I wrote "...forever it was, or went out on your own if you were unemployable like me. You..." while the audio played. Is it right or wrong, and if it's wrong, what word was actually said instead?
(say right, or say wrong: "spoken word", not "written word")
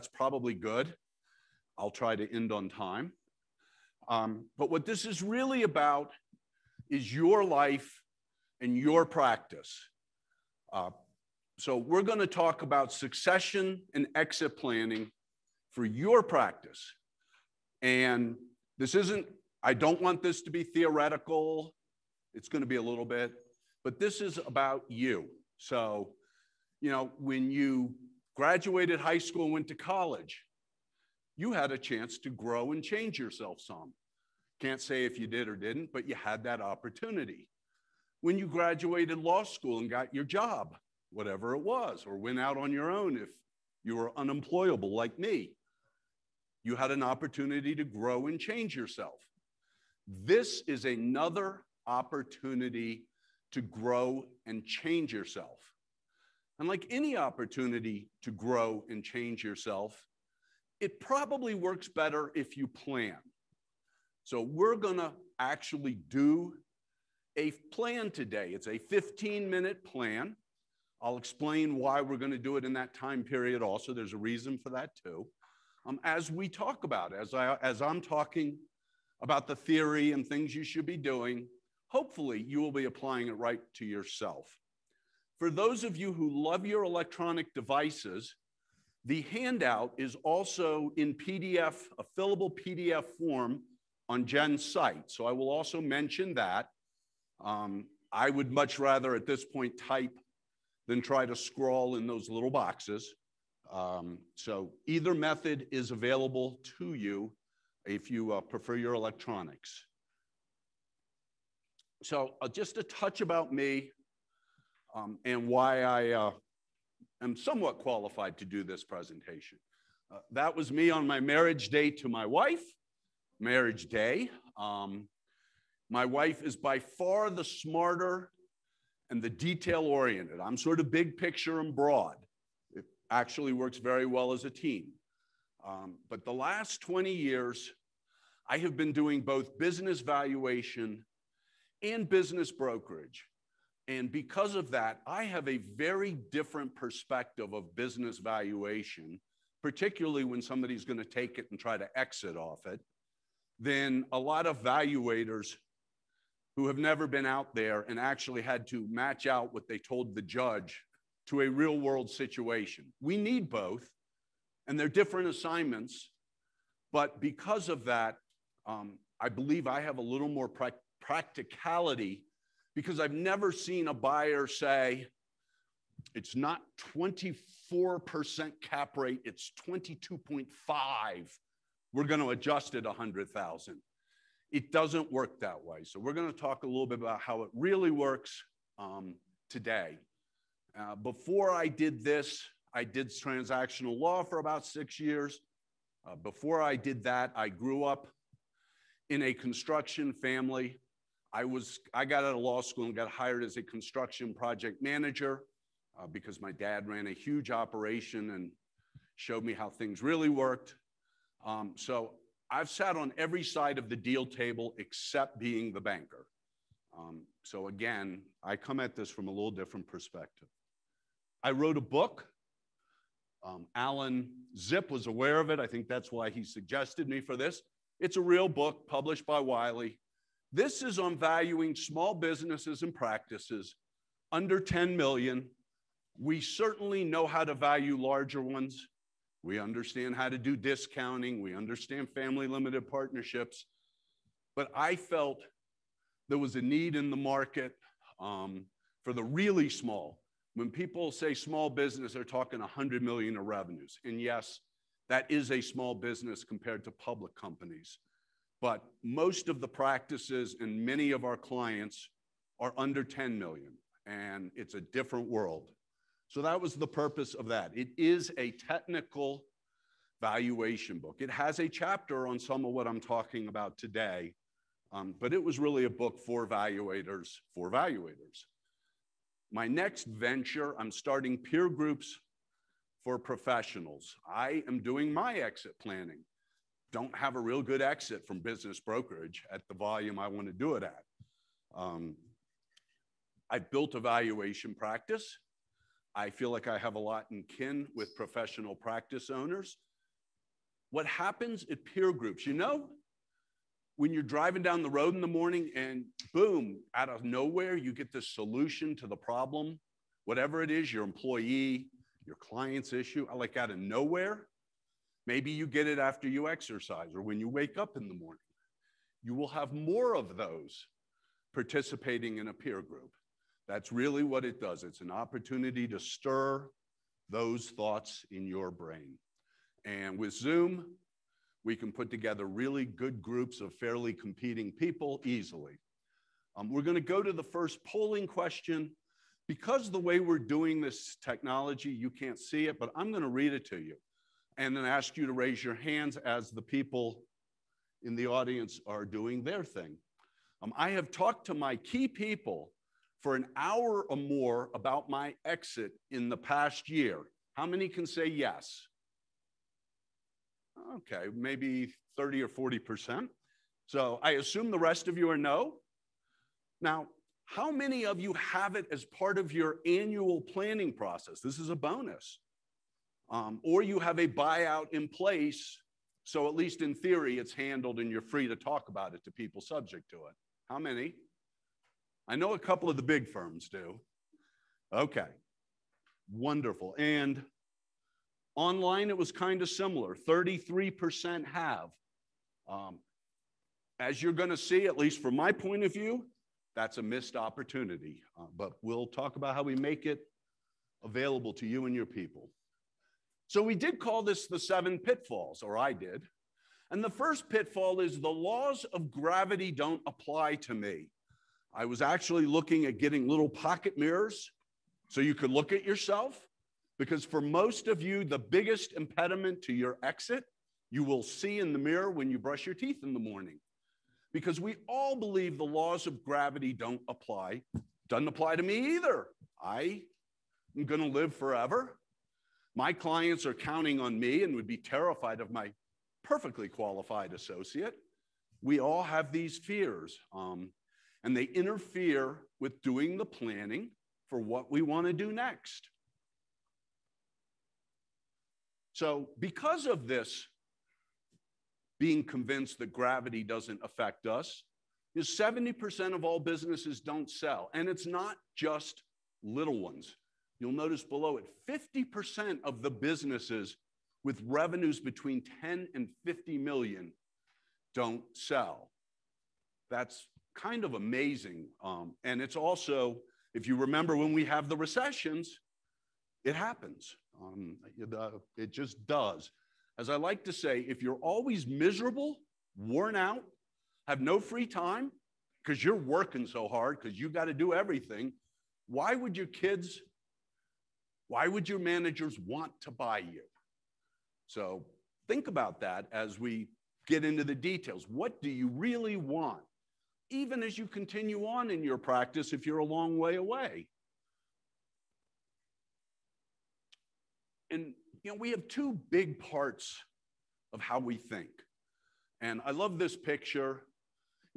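wrong: "whatever", not "forever".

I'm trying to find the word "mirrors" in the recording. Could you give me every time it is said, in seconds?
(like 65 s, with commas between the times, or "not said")
413 s, 421 s.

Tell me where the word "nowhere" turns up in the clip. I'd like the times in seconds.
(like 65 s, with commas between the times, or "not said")
307 s, 313 s.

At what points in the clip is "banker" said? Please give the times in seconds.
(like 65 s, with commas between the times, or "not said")
215 s.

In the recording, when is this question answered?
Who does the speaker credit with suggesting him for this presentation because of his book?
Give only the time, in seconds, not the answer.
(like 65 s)
223 s.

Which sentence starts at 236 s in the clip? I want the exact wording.
We certainly know how to value larger ones.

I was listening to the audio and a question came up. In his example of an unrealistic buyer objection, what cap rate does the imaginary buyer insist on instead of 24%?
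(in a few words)
22.5%.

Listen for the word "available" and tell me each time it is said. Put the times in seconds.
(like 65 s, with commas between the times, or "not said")
105 s, 401 s.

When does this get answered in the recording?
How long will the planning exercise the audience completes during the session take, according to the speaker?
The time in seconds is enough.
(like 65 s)
68 s.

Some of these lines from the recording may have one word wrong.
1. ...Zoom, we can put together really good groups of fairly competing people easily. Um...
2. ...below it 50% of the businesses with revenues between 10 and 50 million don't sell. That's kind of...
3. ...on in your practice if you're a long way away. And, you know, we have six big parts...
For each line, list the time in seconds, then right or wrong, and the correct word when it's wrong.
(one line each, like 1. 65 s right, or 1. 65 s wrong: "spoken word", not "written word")
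1. 330 s right
2. 461 s right
3. 501 s wrong: "two", not "six".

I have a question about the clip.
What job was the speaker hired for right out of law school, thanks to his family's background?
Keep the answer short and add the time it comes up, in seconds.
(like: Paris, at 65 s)
construction project manager, at 203 s.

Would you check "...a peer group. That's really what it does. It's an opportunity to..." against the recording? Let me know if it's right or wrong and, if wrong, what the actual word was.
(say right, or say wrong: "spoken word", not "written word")
right.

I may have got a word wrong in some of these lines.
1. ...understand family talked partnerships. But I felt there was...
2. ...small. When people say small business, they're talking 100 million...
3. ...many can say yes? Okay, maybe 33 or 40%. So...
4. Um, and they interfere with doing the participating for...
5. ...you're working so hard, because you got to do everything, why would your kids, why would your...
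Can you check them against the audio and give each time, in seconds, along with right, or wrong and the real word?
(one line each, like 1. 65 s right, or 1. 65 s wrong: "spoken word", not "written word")
1. 241 s wrong: "limited", not "talked"
2. 249 s right
3. 357 s wrong: "30", not "33"
4. 440 s wrong: "planning", not "participating"
5. 485 s right.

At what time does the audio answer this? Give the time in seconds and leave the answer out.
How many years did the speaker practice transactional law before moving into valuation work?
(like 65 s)
194 s.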